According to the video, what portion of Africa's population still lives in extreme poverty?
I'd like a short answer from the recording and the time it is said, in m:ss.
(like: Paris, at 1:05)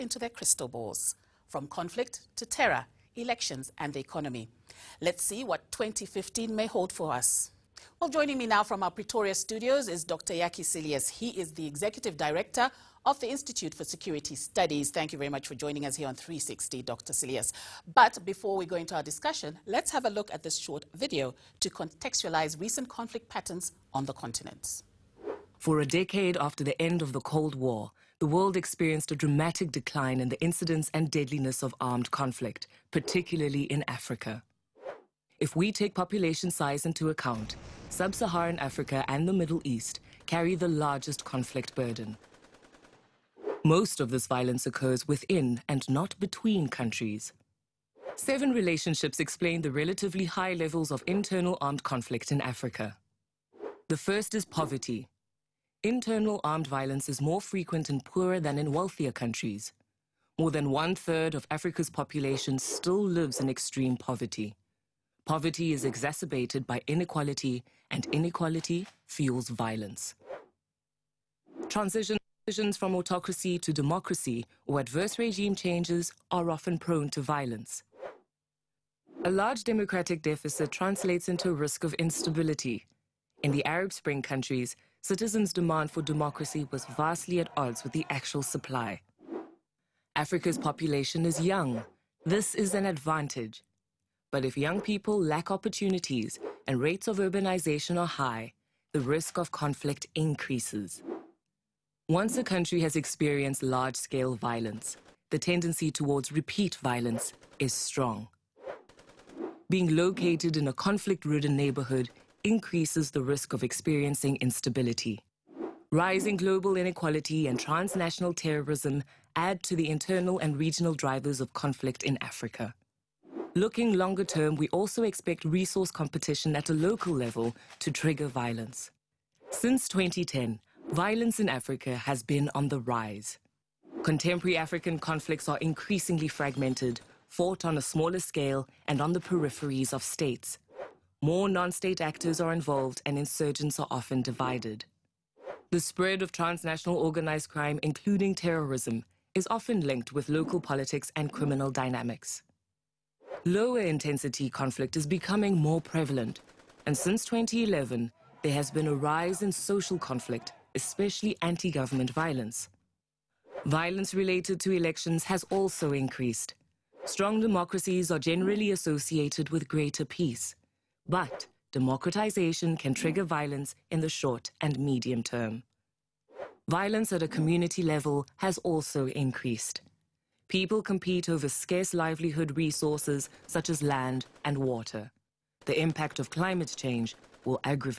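More than one third, at 1:00.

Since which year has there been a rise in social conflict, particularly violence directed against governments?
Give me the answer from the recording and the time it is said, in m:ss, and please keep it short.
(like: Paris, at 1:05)
2011, at 2:37.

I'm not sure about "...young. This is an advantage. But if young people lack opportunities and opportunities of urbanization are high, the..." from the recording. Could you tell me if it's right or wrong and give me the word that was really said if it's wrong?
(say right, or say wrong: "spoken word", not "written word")
wrong: "rates", not "opportunities".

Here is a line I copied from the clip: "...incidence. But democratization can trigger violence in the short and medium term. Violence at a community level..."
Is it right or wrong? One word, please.
wrong.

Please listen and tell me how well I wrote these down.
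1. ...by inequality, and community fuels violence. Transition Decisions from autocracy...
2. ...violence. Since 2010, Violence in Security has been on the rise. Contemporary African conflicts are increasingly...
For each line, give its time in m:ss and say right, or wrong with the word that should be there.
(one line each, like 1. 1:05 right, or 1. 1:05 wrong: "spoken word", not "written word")
1. 1:06 wrong: "inequality", not "community"
2. 2:08 wrong: "Africa", not "Security".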